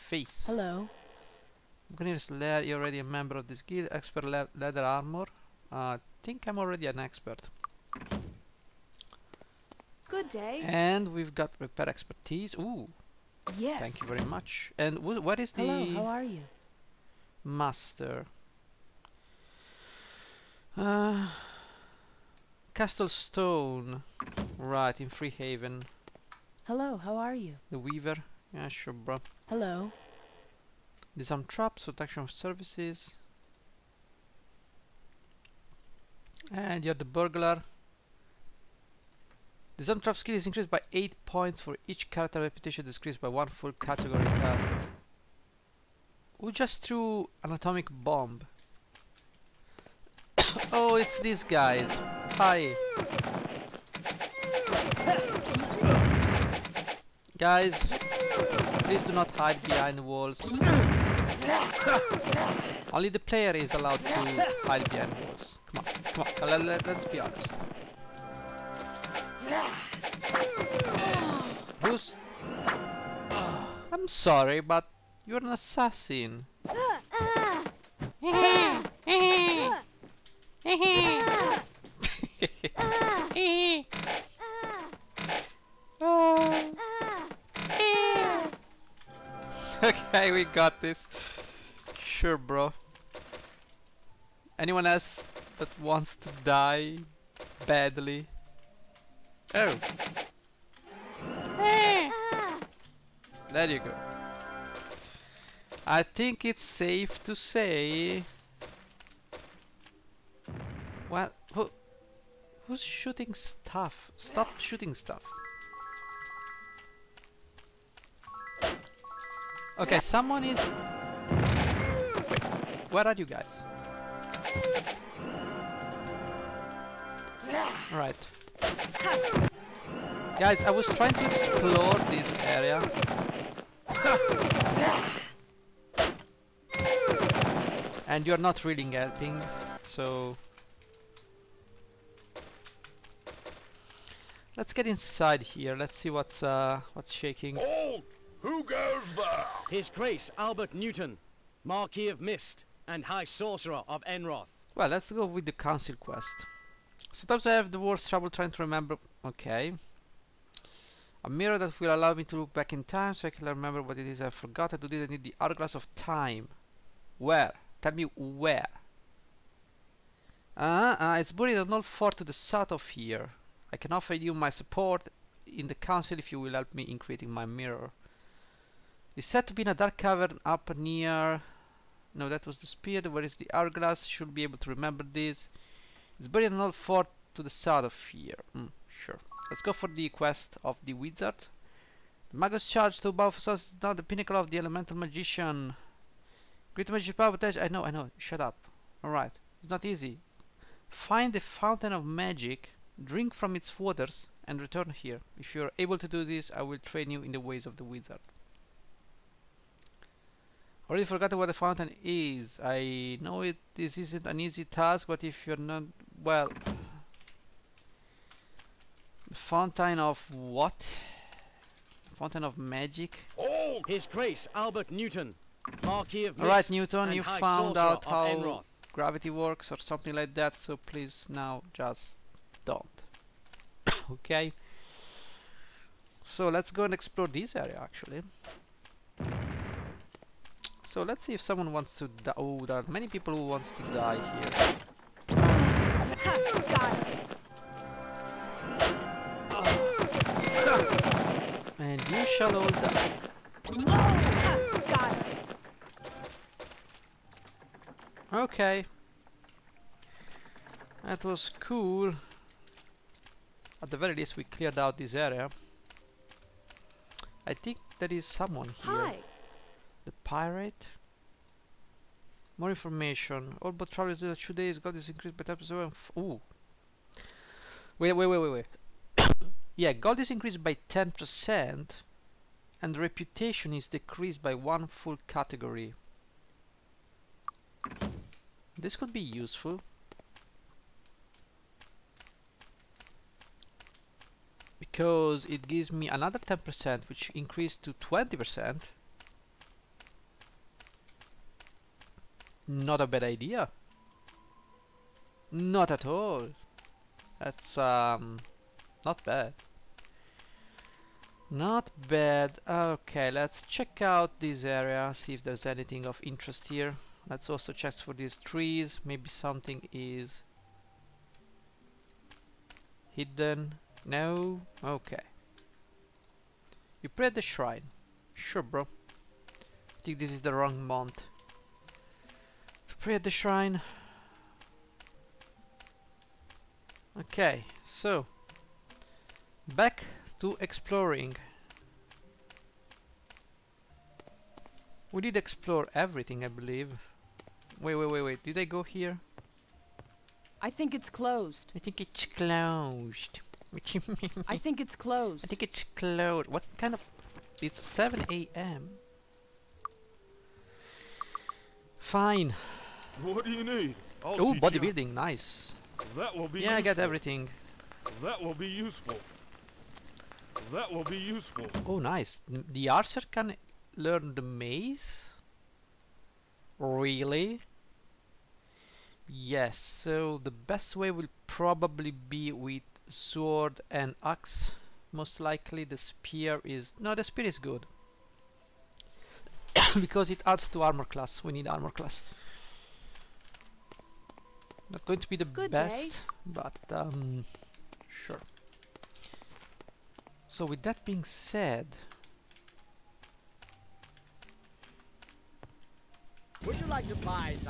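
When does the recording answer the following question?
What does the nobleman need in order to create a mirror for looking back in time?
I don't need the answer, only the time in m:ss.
2:45.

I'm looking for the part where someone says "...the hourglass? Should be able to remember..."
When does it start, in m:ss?
3:03.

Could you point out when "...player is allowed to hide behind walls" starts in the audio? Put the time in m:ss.
1:03.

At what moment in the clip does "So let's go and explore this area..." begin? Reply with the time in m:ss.
3:56.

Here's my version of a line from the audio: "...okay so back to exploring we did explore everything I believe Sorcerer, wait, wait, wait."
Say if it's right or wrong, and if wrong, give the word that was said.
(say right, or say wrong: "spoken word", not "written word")
wrong: "Wait", not "Sorcerer".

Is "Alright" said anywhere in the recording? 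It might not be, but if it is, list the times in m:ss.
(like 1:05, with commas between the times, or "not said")
3:19, 3:46.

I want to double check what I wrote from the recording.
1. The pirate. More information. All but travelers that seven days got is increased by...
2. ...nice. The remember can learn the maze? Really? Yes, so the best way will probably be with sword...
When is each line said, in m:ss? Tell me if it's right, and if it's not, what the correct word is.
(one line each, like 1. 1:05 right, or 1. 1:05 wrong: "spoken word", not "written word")
1. 4:30 wrong: "two", not "seven"
2. 6:11 wrong: "archer", not "remember".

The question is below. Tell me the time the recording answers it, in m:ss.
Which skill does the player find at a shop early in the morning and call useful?
6:04.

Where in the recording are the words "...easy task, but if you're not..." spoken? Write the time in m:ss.
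3:34.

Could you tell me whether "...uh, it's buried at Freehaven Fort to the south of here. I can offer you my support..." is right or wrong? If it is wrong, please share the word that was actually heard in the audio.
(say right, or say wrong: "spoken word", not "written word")
wrong: "Knoll", not "Freehaven".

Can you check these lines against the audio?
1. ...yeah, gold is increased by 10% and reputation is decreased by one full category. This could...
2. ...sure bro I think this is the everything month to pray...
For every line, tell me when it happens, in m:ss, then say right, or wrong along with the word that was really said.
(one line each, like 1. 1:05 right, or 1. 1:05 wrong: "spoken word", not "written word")
1. 4:39 right
2. 5:28 wrong: "wrong", not "everything".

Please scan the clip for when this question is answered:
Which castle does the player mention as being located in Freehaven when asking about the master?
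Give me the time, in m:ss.
0:22.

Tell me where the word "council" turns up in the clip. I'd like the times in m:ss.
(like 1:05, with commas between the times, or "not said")
2:35, 2:55.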